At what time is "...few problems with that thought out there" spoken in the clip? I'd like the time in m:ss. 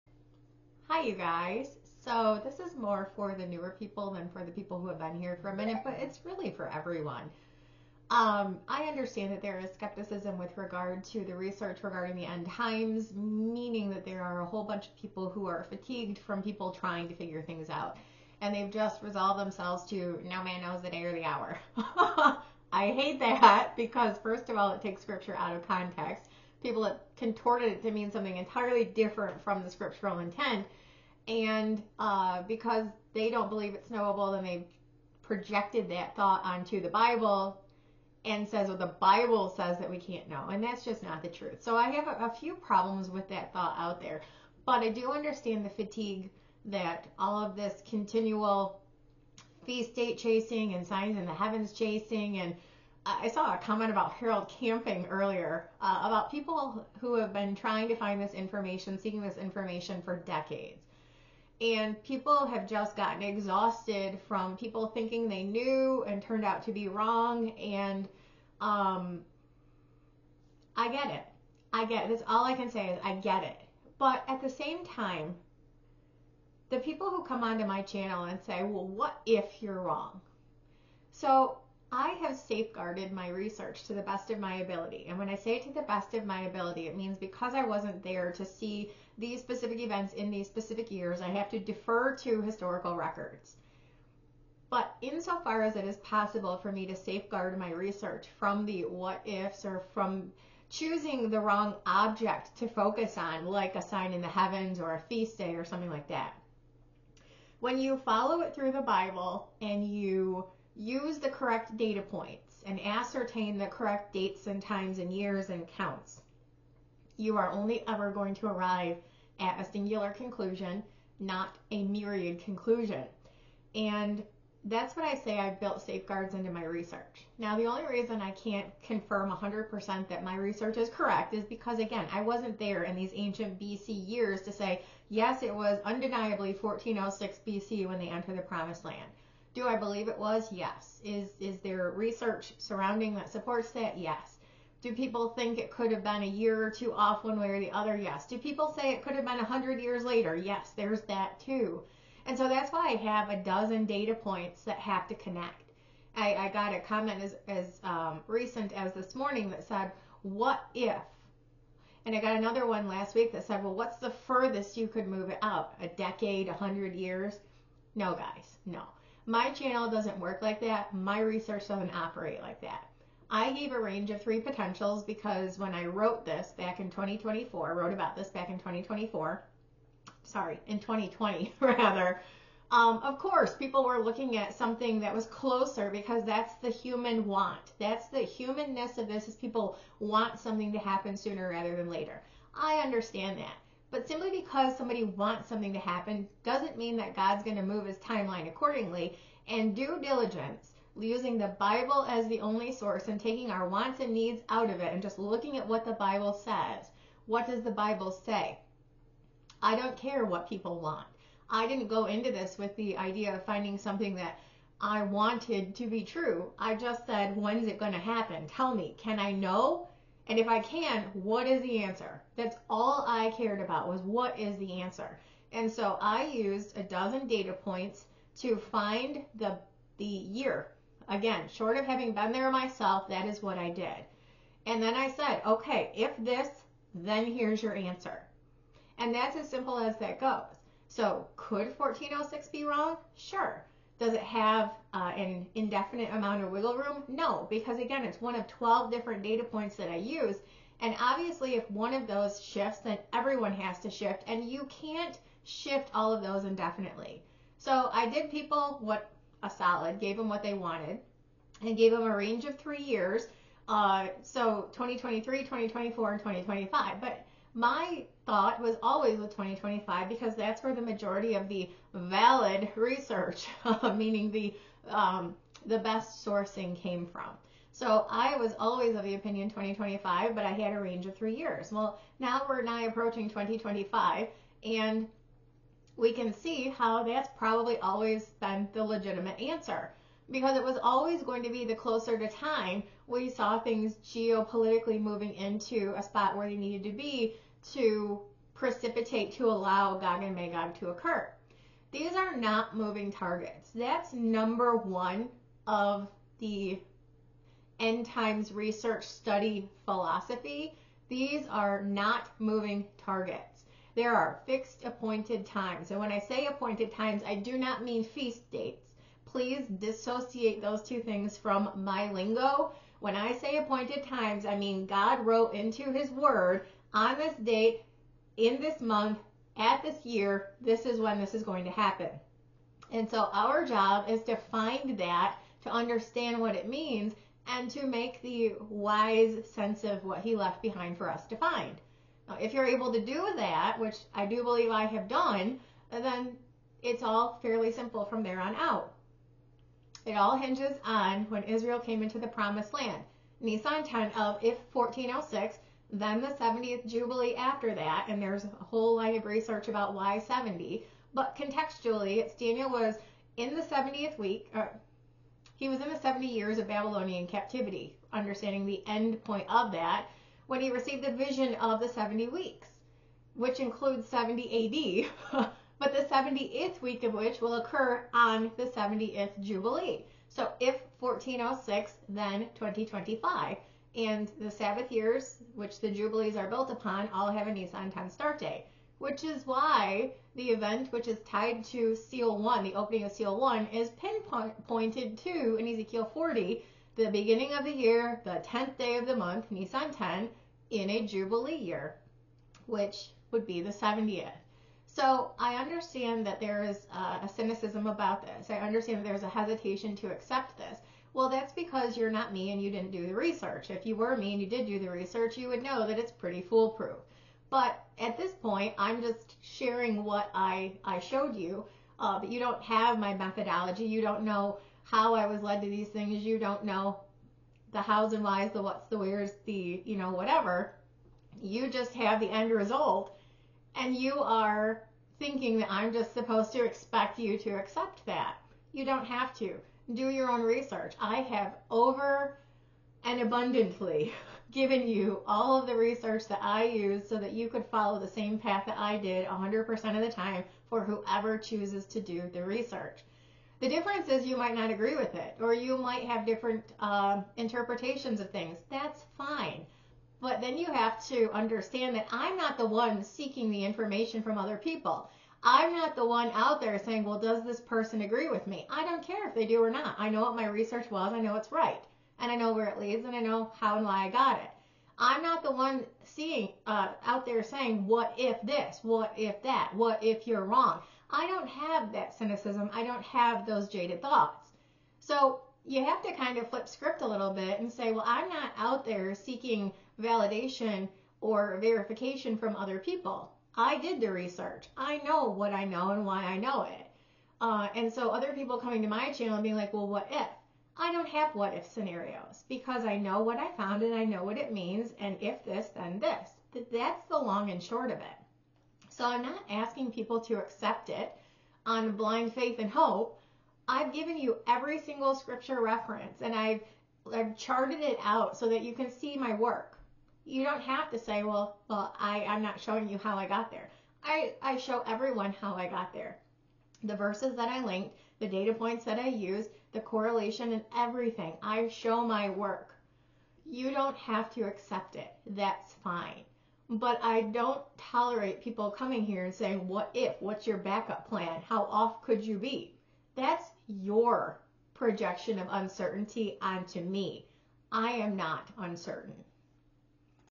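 0:42.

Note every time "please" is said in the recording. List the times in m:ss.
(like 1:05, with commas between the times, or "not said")
5:19.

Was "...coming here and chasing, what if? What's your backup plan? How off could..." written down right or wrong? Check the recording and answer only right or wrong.
wrong.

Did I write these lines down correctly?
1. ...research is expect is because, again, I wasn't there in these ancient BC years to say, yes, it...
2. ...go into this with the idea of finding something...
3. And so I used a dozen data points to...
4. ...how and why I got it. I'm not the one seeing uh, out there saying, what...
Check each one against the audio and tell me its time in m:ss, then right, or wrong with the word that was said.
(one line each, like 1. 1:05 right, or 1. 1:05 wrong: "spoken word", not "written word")
1. 2:10 wrong: "correct", not "expect"
2. 3:31 right
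3. 3:45 right
4. 7:53 right.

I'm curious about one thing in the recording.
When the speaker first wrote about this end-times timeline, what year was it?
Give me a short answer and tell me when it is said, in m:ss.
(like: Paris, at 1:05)
2020, at 3:00.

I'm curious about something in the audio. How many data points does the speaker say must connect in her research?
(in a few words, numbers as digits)
12.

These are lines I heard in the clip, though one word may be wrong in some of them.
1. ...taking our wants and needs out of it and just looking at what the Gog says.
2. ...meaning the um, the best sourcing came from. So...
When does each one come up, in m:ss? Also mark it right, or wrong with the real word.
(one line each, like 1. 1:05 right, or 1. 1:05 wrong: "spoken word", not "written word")
1. 3:23 wrong: "Bible", not "Gog"
2. 4:33 right.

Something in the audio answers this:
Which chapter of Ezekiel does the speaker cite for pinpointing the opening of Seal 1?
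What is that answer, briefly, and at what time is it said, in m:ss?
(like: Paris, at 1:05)
Ezekiel 40, at 6:35.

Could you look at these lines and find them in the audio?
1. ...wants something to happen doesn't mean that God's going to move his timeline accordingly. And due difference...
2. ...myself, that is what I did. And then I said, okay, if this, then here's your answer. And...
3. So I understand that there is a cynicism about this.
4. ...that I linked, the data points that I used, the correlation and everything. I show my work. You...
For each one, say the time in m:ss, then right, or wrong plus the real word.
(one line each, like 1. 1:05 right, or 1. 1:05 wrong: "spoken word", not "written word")
1. 3:15 wrong: "diligence", not "difference"
2. 3:52 right
3. 6:44 right
4. 8:47 right.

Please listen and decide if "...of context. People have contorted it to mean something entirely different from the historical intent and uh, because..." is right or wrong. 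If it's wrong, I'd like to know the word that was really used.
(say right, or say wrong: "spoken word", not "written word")
wrong: "scriptural", not "historical".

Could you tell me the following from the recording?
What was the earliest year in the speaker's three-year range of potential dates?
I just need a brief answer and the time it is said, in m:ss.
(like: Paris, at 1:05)
2023, at 4:24.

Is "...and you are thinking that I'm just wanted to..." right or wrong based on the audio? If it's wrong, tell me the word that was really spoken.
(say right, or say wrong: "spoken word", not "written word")
wrong: "supposed", not "wanted".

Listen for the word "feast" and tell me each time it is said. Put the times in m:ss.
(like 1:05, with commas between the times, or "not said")
0:49, 1:45, 5:18.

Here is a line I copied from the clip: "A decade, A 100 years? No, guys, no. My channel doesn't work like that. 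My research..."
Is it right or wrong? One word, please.
right.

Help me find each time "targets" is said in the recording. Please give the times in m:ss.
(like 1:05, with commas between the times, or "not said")
5:03, 5:12.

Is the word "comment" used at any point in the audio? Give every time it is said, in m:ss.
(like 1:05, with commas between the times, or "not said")
0:53, 2:36.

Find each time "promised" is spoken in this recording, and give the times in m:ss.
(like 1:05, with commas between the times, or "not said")
2:18, 5:52.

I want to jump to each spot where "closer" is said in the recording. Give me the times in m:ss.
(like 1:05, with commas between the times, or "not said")
3:05, 4:51.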